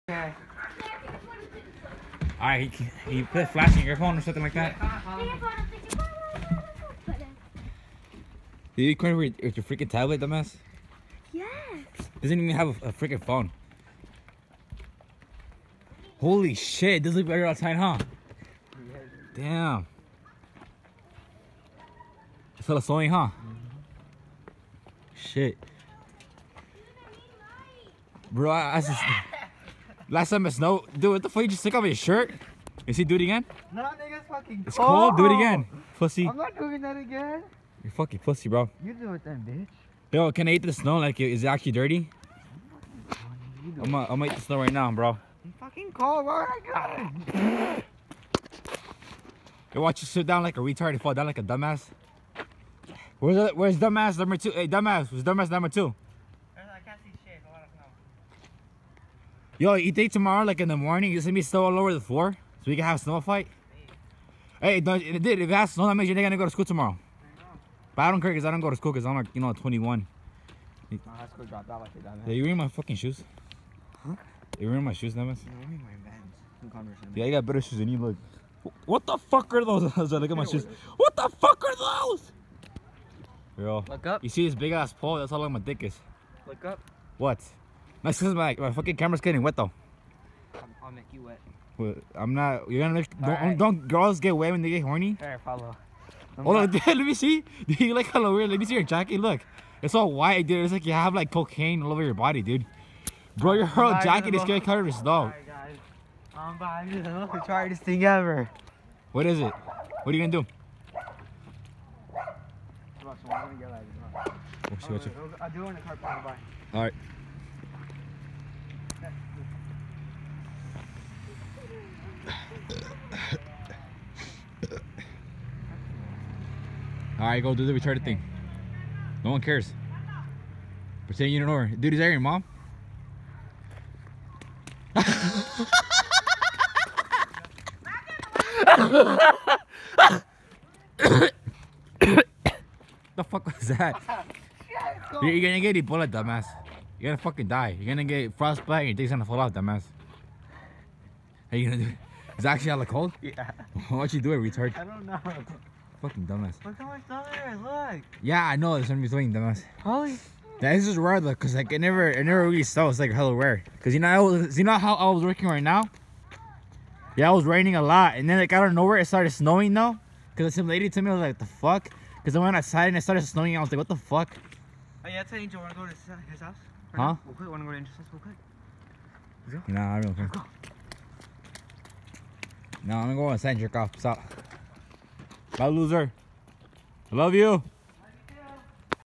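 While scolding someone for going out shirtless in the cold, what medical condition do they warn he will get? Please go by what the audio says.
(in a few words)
Frostbite.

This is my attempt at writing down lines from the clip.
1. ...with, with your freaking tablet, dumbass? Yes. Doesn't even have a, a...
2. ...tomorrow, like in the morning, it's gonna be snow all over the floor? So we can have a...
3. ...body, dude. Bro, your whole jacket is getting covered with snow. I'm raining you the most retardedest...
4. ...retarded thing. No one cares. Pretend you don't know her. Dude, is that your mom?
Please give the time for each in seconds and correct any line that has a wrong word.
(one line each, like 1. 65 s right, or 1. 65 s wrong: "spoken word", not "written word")
1. 9 s right
2. 60 s right
3. 102 s wrong: "buying", not "raining"
4. 127 s right.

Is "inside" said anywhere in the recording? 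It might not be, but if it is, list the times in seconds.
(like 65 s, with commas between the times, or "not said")
183 s.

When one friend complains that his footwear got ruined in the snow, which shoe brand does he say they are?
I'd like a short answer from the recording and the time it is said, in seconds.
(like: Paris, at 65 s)
Vans, at 76 s.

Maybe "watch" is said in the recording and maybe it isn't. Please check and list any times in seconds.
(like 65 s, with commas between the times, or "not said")
49 s.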